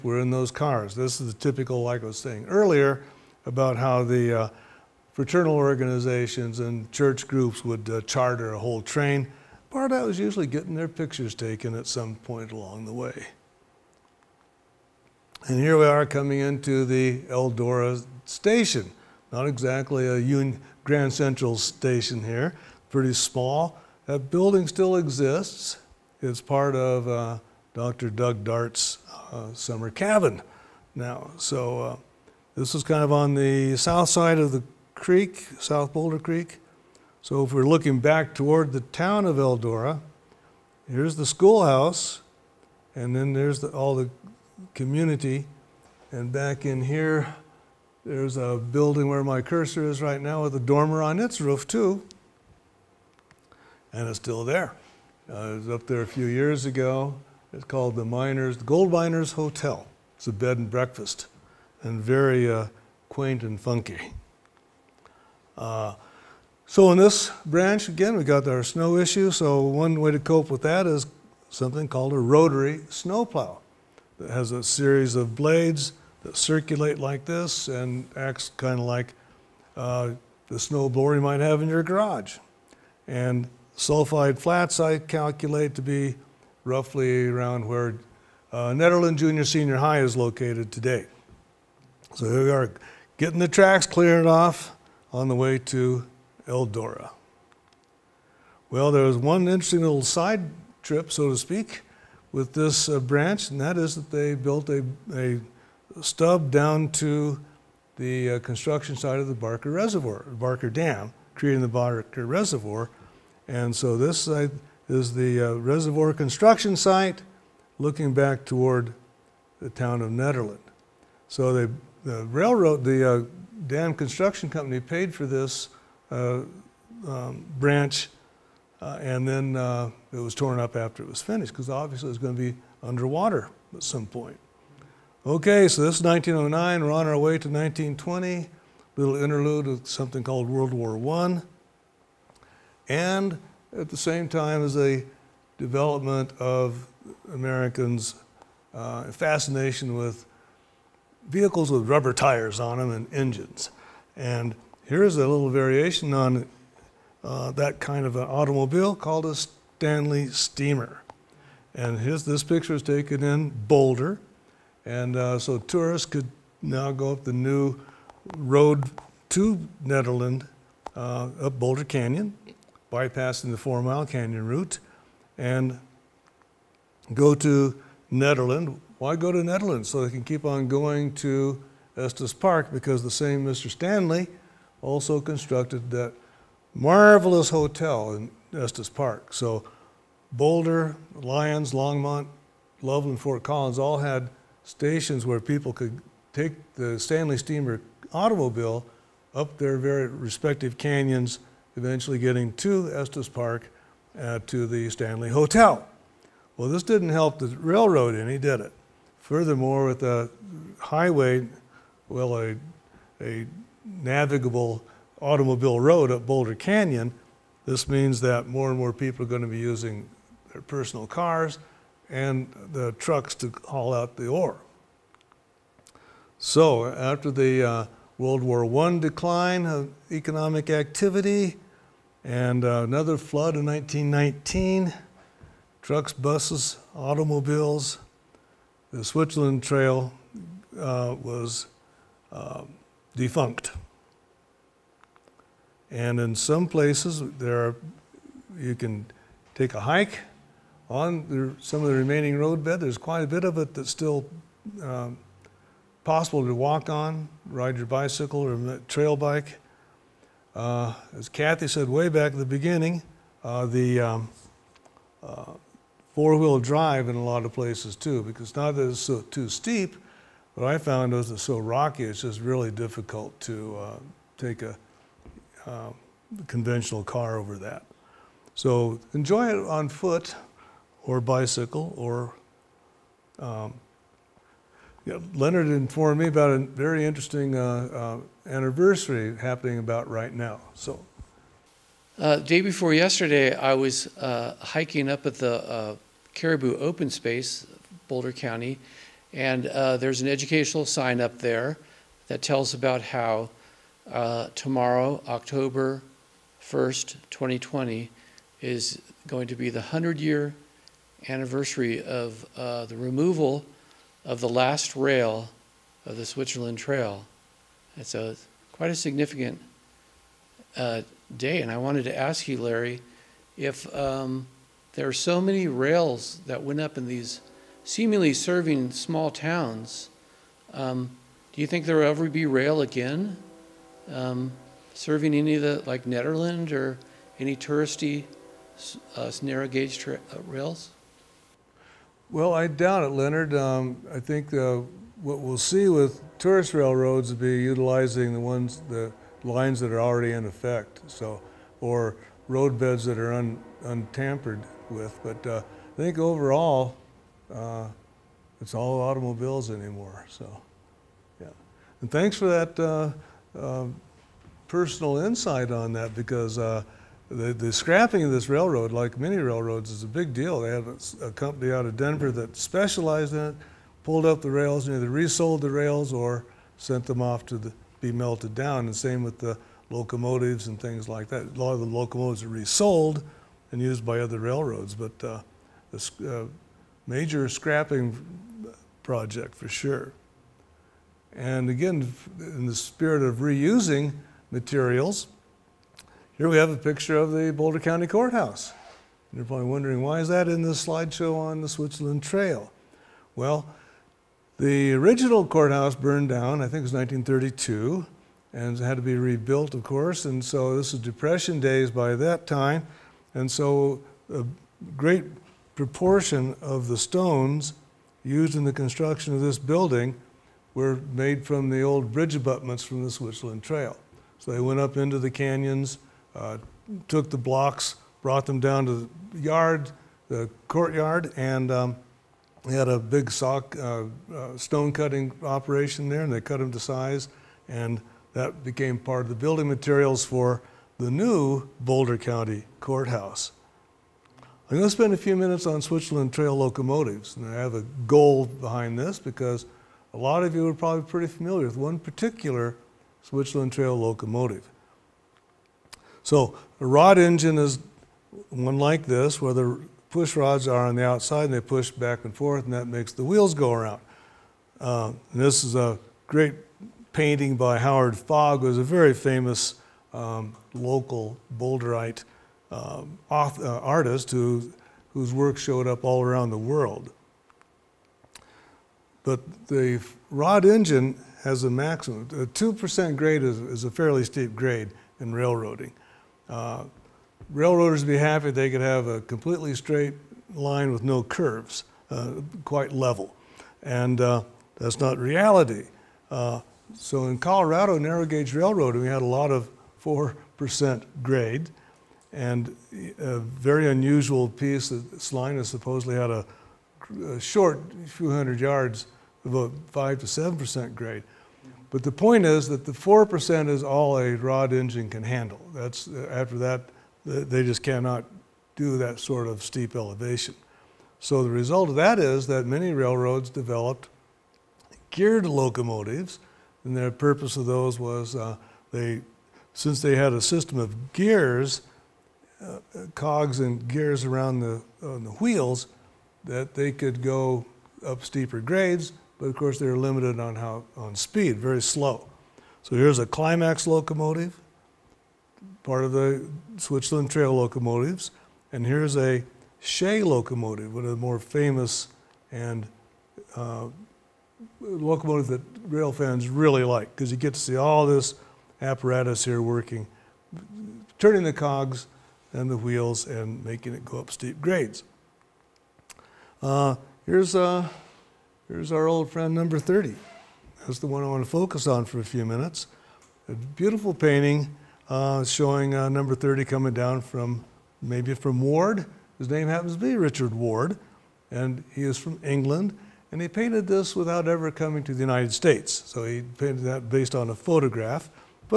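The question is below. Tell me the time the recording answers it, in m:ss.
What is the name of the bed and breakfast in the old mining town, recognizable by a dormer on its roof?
0:58.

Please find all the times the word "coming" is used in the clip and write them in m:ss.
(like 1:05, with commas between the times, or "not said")
0:16, 9:36, 9:44.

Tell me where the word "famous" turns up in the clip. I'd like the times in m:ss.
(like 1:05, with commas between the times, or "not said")
7:49, 9:11.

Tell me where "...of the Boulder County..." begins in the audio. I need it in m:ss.
6:37.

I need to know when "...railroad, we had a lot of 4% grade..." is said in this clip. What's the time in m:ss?
8:18.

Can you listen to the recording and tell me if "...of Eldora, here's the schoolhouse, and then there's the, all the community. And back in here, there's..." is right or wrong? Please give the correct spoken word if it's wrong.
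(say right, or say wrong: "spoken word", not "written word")
right.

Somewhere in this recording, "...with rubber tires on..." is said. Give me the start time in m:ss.
2:31.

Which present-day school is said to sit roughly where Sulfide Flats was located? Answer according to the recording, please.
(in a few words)
Nederland Junior Senior High.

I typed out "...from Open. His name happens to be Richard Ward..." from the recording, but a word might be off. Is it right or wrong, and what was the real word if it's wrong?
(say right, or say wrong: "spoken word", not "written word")
wrong: "Ward", not "Open".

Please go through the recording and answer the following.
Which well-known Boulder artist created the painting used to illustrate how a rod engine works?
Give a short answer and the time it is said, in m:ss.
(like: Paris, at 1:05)
Howard Fogg, at 7:47.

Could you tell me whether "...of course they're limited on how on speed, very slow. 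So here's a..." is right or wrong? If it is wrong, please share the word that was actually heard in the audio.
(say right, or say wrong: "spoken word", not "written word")
right.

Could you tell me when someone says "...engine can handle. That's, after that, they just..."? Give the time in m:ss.
8:34.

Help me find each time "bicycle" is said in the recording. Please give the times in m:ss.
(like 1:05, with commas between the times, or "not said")
4:17, 4:41.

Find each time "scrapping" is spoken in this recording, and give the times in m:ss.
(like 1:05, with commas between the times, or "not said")
6:07, 6:27.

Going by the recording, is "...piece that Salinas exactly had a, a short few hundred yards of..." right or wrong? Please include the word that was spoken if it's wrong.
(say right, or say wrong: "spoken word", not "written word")
wrong: "supposedly", not "exactly".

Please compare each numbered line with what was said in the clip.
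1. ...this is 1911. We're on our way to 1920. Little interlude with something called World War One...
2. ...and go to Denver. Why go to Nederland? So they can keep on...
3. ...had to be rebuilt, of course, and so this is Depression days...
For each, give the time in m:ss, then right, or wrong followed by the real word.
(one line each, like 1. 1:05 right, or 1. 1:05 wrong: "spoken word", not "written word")
1. 2:15 wrong: "1909", not "1911"
2. 2:55 wrong: "Nederland", not "Denver"
3. 6:48 right.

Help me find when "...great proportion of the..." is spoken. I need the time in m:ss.
6:54.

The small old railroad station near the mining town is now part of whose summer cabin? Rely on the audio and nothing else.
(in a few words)
Dr. Doug Dart.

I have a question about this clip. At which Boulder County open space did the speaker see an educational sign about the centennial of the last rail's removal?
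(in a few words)
Caribou Open Space.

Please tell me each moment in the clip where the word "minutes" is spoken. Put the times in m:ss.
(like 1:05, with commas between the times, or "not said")
7:25, 9:32.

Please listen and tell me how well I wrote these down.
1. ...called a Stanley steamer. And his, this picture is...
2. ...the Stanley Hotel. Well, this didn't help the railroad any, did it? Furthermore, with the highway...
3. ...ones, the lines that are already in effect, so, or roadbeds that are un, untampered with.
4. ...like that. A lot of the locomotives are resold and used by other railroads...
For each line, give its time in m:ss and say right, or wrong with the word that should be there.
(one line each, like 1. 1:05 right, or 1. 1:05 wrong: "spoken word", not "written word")
1. 2:38 right
2. 3:24 right
3. 5:48 right
4. 6:21 right.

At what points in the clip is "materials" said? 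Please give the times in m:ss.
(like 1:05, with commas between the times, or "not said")
6:34, 7:19.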